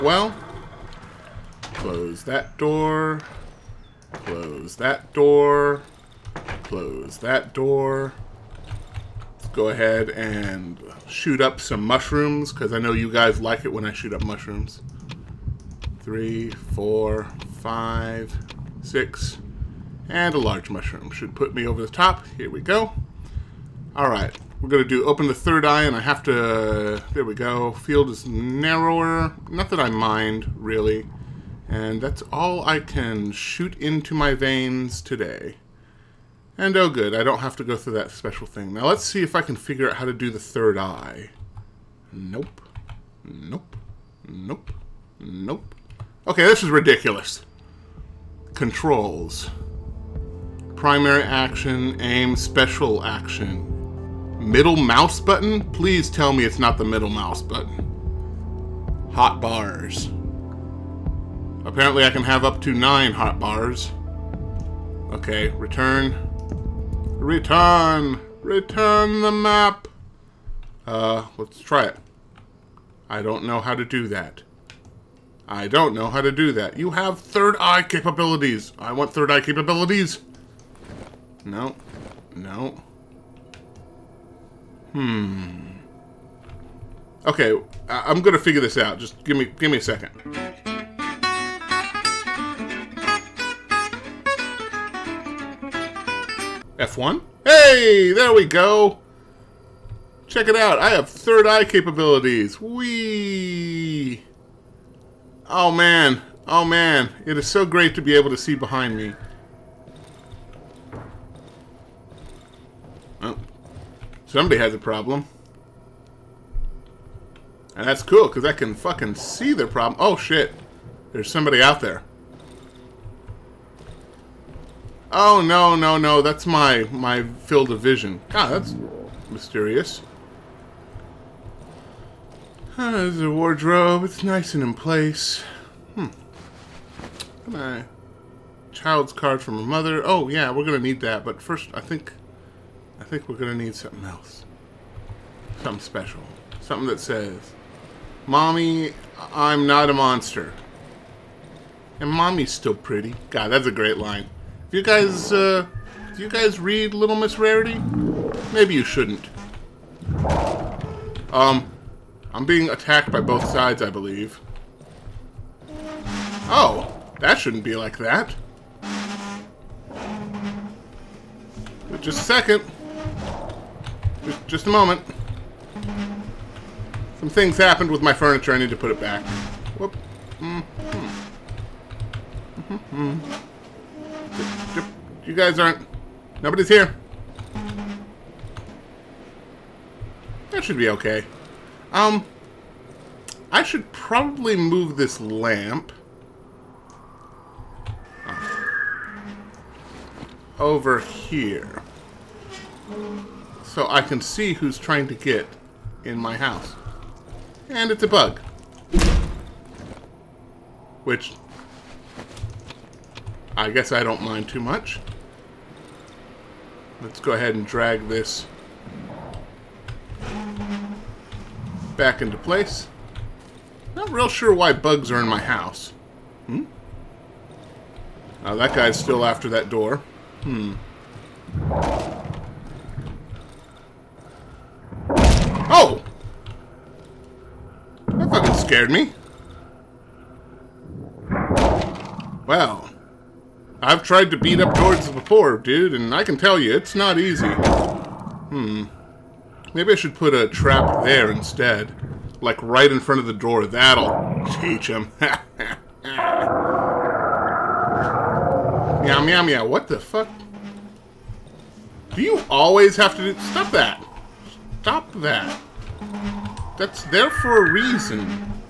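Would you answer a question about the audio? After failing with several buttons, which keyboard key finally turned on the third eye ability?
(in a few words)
F1.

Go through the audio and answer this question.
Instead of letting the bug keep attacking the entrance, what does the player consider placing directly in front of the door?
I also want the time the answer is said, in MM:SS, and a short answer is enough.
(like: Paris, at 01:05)
A trap, at 04:10.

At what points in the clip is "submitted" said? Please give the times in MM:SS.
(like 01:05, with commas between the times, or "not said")
not said.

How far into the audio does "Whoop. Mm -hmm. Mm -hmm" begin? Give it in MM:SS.
02:59.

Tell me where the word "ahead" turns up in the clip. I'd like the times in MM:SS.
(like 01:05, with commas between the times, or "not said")
00:09, 03:37.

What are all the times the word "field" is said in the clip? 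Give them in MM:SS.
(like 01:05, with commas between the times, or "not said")
00:27, 02:07.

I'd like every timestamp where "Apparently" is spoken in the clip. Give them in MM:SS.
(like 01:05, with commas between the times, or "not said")
01:01.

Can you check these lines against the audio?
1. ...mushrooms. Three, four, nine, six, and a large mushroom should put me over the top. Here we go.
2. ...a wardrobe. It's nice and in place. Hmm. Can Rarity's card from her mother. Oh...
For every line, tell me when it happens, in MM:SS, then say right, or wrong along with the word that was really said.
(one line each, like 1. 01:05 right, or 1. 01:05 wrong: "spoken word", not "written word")
1. 00:14 wrong: "five", not "nine"
2. 02:13 wrong: "Child", not "Rarity".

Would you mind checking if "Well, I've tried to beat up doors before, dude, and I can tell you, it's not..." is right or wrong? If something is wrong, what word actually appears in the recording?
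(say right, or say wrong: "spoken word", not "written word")
right.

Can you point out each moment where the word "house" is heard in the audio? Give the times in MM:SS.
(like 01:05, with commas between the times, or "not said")
03:26, 03:45.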